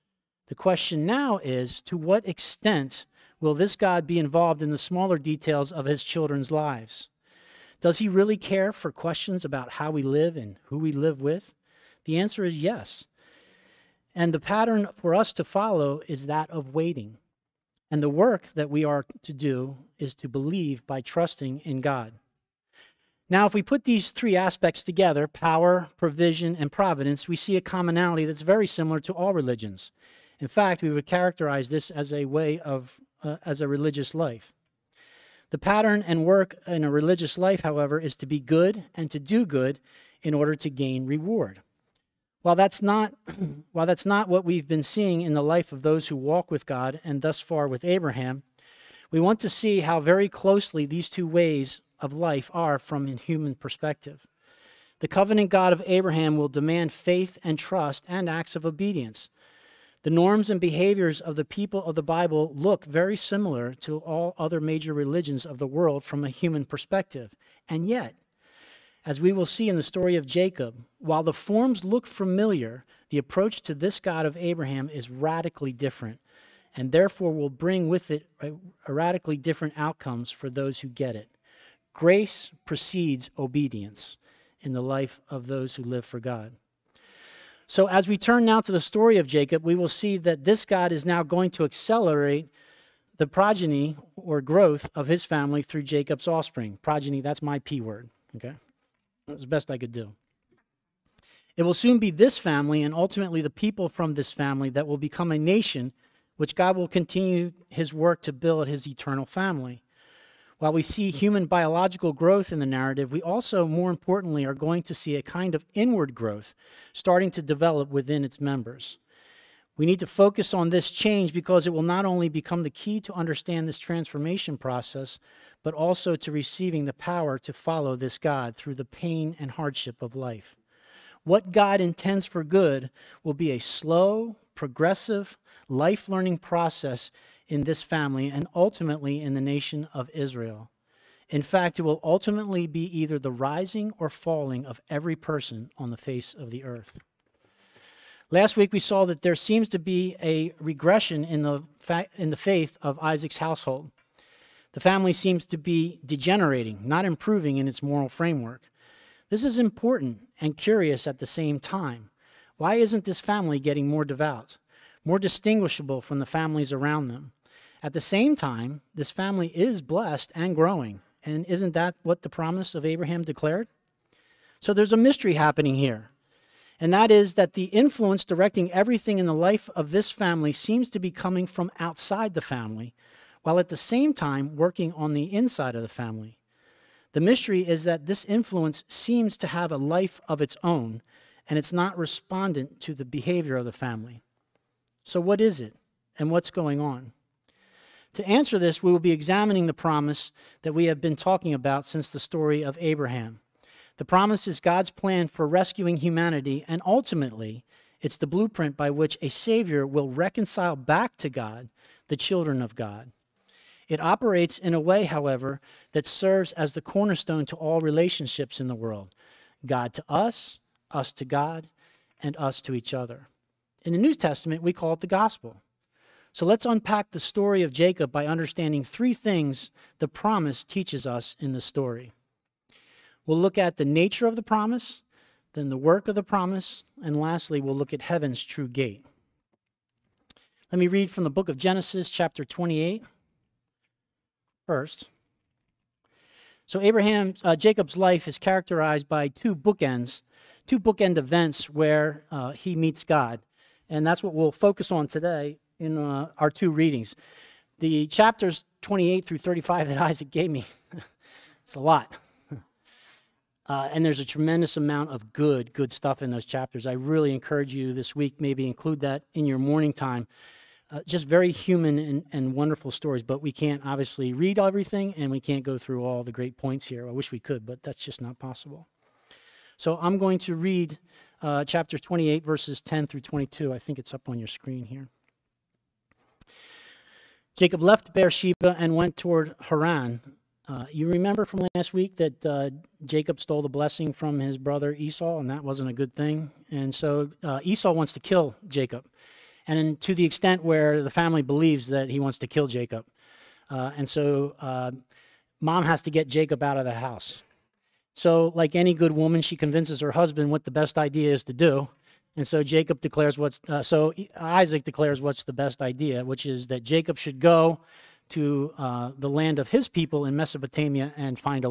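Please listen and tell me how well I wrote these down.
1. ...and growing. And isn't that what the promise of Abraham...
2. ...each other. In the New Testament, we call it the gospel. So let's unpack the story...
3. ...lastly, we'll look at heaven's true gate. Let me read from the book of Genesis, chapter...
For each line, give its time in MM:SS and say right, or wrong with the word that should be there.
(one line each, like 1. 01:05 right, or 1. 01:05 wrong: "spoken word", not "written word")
1. 02:50 right
2. 03:42 right
3. 03:57 right.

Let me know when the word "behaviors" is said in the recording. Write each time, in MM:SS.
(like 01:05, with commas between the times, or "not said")
01:00, 03:13.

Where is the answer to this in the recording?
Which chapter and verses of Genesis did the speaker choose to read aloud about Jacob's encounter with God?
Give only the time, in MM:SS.
04:41.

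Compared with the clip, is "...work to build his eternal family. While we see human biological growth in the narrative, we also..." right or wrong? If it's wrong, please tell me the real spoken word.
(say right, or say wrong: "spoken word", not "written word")
right.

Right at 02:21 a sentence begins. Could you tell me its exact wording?
In fact, it will ultimately be either the rising or falling of every person on the face of the earth.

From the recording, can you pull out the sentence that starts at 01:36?
Progeny, that's my P word, okay?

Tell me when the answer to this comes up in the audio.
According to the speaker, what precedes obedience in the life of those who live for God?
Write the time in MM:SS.
01:21.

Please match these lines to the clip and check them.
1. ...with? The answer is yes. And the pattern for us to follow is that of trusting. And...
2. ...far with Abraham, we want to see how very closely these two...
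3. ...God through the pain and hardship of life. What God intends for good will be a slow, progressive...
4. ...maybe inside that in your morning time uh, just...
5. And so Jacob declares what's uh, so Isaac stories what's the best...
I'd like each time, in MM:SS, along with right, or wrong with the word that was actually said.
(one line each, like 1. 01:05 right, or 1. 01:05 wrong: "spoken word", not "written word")
1. 00:11 wrong: "waiting", not "trusting"
2. 00:47 right
3. 02:08 right
4. 04:28 wrong: "include", not "inside"
5. 05:12 wrong: "declares", not "stories".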